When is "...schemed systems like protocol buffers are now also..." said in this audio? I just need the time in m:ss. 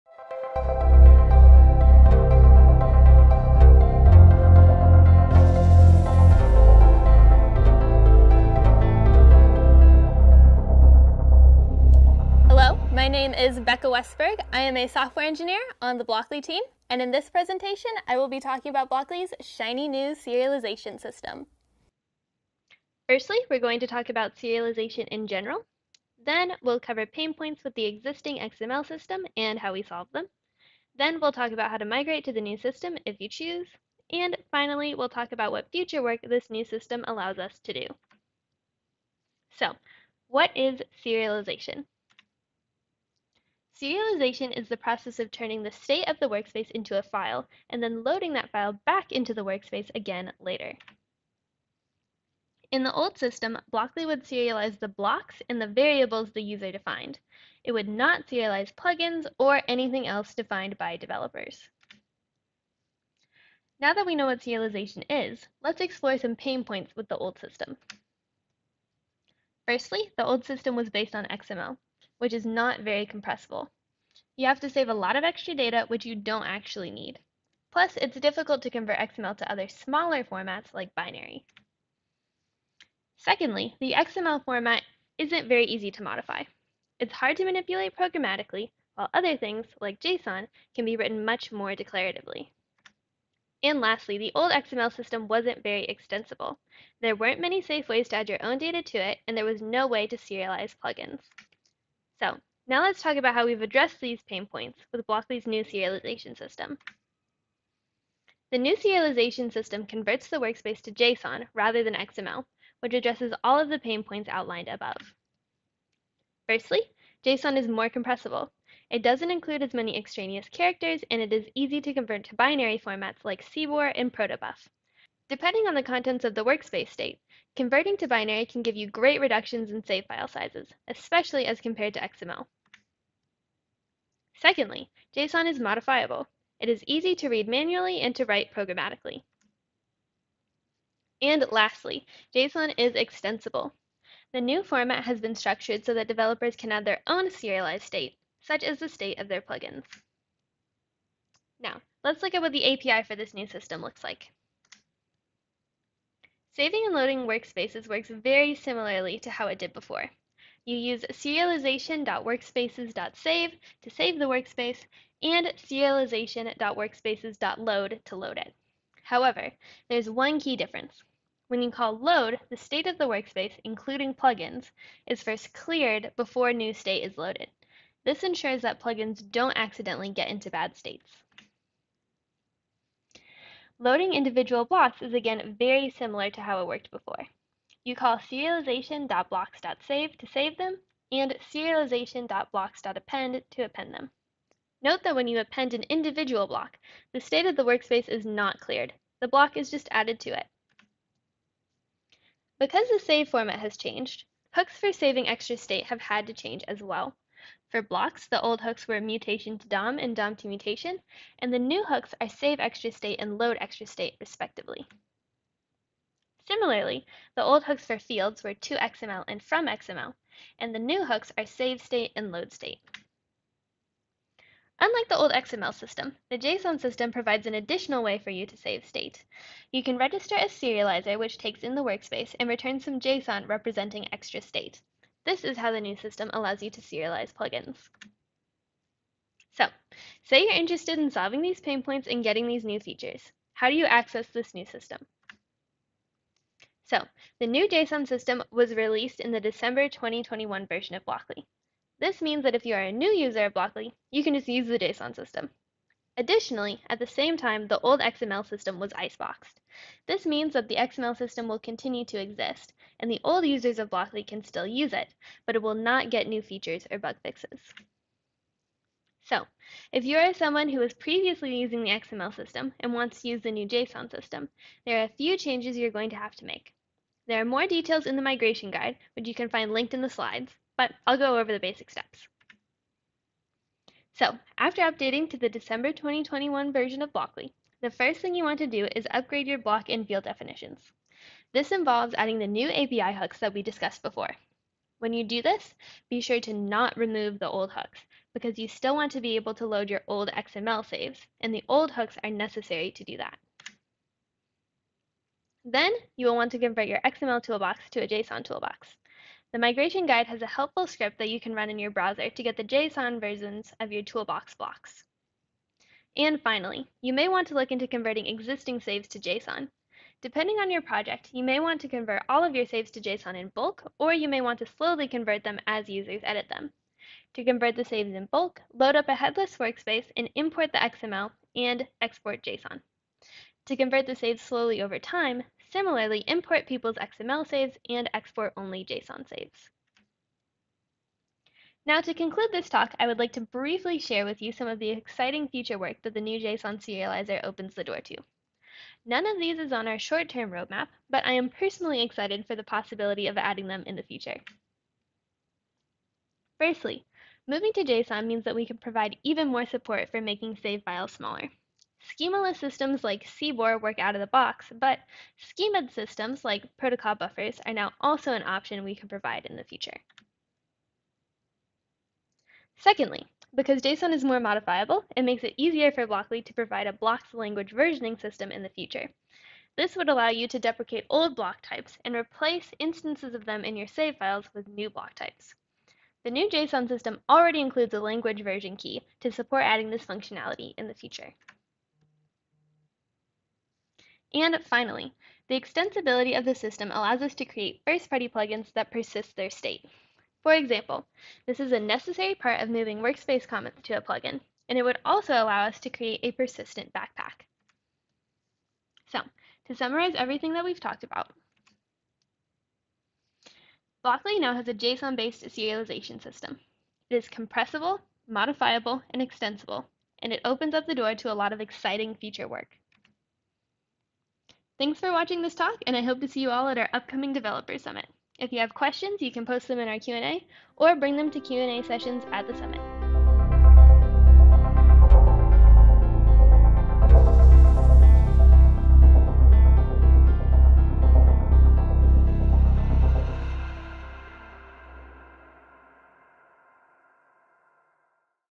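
6:05.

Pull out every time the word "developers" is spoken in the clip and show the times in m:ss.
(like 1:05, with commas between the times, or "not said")
1:00, 2:26, 7:07.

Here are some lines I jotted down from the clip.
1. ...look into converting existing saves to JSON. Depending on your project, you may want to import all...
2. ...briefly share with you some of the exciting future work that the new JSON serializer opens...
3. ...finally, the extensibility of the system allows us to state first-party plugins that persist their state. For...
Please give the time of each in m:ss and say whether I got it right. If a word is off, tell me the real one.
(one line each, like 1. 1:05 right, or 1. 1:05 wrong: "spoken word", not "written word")
1. 5:17 wrong: "convert", not "import"
2. 5:43 right
3. 6:34 wrong: "create", not "state".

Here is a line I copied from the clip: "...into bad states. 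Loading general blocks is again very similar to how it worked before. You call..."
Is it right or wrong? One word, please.
wrong.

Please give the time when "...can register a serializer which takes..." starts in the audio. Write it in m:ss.
3:49.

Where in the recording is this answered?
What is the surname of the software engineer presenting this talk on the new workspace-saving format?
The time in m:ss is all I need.
0:13.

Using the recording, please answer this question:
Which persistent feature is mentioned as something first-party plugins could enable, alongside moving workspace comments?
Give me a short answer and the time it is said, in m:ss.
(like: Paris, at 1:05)
persistent backpack, at 6:46.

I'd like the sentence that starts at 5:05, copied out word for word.
Then you will want to convert your XML toolbox to a JSON toolbox.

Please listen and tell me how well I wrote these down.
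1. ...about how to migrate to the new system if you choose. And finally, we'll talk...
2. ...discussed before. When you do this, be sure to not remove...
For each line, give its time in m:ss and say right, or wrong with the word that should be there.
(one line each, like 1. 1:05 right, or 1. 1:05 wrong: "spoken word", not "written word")
1. 0:31 right
2. 4:53 right.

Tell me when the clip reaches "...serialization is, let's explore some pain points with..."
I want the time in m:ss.
1:04.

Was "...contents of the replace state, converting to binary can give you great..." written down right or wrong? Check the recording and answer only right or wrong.
wrong.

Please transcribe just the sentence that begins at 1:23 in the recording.
Secondly, the XML format isn't very easy to modify.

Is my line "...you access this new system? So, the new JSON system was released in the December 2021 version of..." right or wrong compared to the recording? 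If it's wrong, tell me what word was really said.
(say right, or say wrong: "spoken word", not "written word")
right.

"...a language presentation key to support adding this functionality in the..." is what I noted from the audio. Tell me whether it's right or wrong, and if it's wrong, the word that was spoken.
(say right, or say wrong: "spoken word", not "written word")
wrong: "version", not "presentation".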